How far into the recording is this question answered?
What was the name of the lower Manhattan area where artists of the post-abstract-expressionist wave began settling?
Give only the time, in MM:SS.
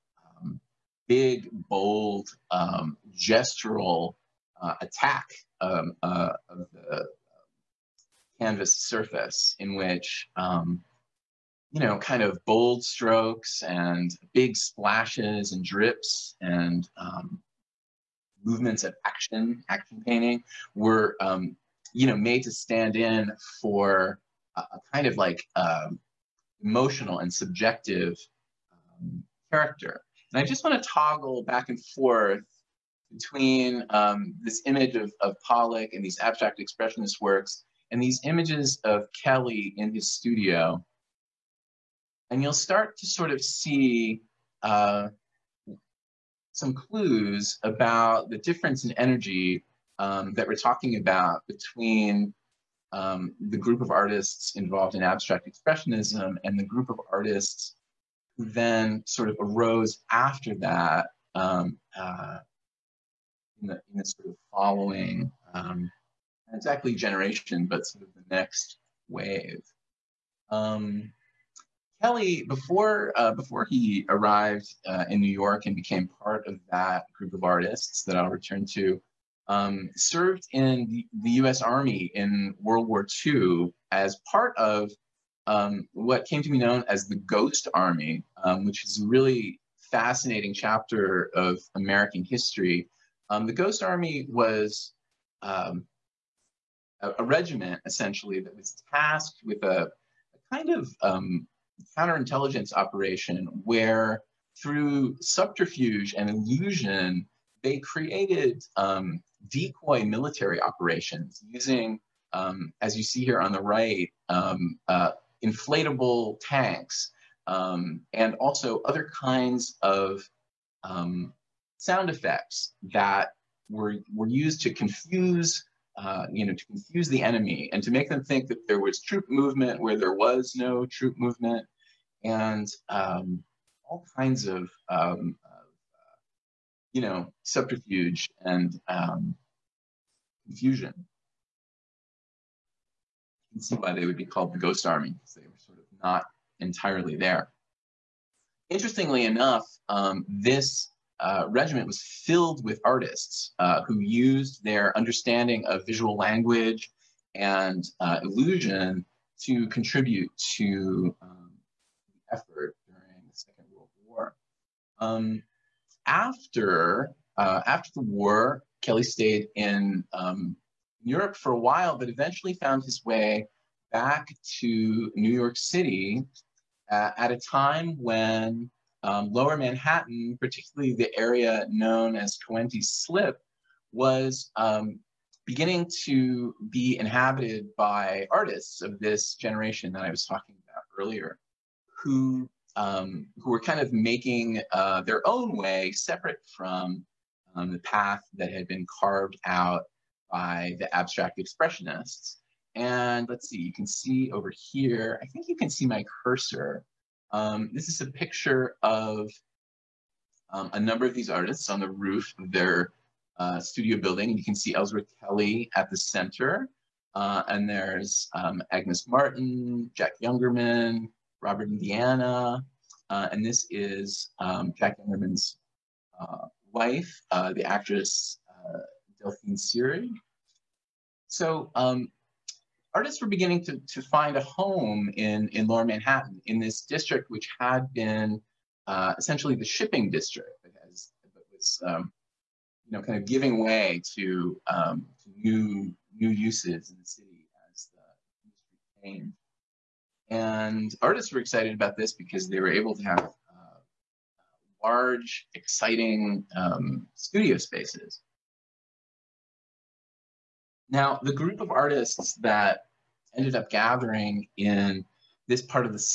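03:02.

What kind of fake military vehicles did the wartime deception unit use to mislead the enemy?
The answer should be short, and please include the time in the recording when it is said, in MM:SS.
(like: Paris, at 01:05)
inflatable tanks, at 01:55.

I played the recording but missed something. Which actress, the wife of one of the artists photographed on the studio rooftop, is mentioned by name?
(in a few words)
Delphine Seyrig.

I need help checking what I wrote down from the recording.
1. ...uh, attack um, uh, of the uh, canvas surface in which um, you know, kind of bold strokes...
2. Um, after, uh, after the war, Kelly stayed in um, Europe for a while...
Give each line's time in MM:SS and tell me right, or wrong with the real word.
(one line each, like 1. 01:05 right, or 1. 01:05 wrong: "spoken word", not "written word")
1. 00:04 right
2. 02:45 right.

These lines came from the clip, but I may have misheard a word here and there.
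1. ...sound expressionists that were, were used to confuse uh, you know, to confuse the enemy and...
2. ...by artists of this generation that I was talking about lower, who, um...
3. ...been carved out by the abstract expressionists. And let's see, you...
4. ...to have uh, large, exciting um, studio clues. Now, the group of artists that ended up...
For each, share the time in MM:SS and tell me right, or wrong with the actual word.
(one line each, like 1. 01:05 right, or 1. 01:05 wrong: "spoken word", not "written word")
1. 02:01 wrong: "effects", not "expressionists"
2. 03:07 wrong: "earlier", not "lower"
3. 03:18 right
4. 04:12 wrong: "spaces", not "clues".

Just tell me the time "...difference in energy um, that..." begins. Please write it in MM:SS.
00:48.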